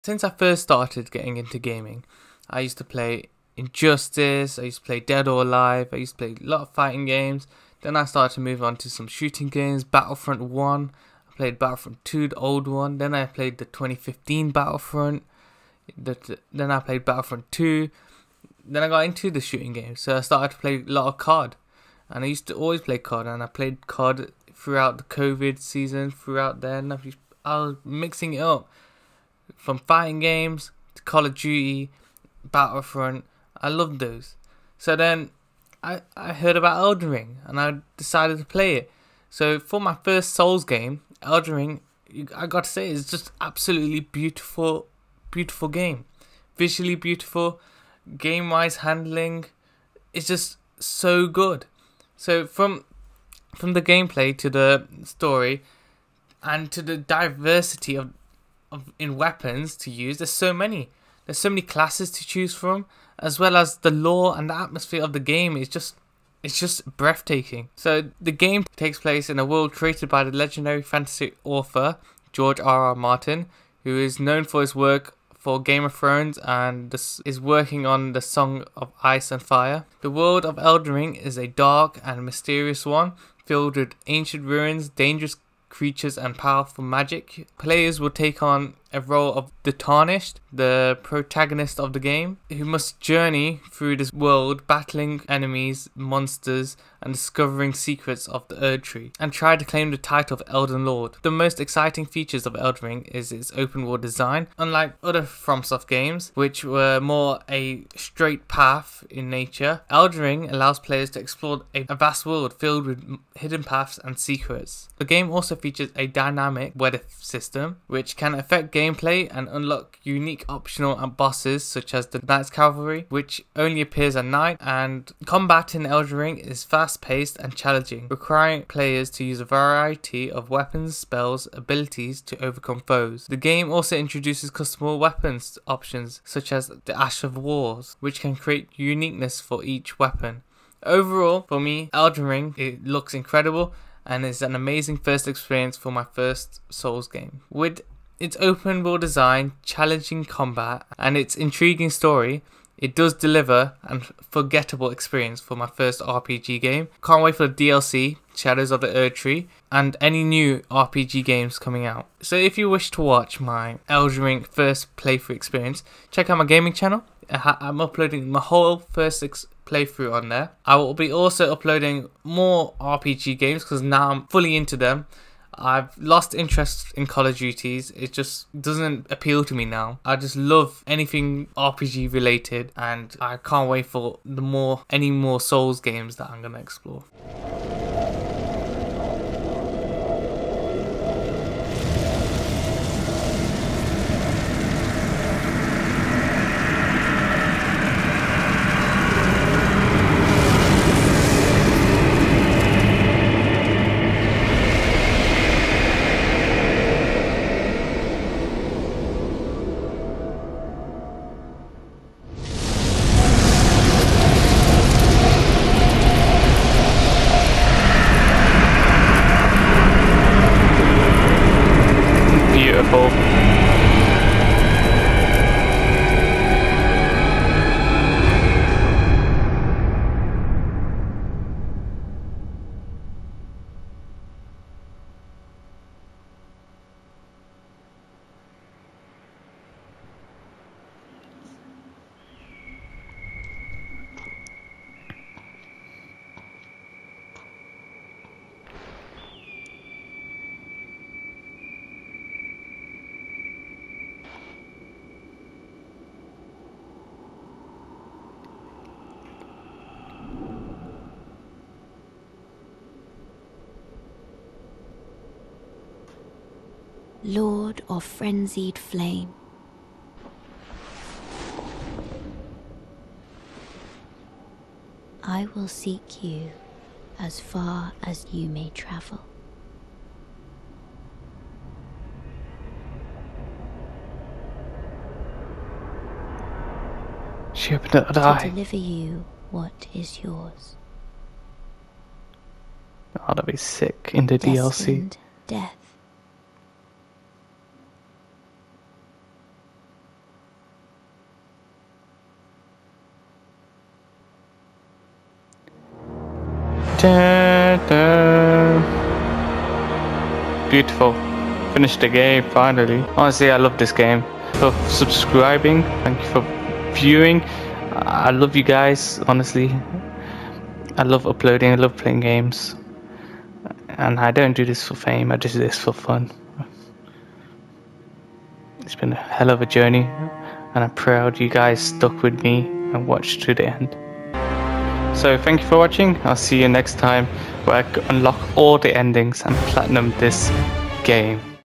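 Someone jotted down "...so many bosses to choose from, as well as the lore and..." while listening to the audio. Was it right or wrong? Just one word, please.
wrong.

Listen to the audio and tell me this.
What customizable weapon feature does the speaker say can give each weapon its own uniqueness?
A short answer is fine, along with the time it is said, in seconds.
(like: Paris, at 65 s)
Ash of Wars, at 136 s.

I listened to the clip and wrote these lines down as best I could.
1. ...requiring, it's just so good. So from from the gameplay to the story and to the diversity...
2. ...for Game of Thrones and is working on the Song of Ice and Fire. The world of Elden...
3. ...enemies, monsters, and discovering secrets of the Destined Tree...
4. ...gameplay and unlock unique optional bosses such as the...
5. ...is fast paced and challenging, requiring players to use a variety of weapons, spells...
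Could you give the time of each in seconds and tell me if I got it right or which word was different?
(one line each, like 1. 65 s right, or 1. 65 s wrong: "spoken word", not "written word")
1. 48 s wrong: "handling", not "requiring"
2. 75 s right
3. 95 s wrong: "Erd", not "Destined"
4. 118 s right
5. 126 s right.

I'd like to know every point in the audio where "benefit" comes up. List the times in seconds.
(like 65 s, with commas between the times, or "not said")
not said.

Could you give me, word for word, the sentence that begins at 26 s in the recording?
I was mixing it up from fighting games to Call of Duty, Battlefront, I loved those.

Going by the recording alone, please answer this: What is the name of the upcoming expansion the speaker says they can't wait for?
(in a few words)
Shadows of the Erd Tree.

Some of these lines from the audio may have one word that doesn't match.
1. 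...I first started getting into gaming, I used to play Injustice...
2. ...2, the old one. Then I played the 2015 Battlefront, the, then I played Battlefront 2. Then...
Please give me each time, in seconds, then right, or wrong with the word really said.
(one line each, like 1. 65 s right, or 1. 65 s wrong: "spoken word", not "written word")
1. 0 s right
2. 12 s right.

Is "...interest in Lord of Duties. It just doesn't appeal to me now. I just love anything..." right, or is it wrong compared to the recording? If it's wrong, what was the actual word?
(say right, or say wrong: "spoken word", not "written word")
wrong: "Call", not "Lord".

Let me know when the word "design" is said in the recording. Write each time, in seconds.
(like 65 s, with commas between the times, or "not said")
104 s, 149 s.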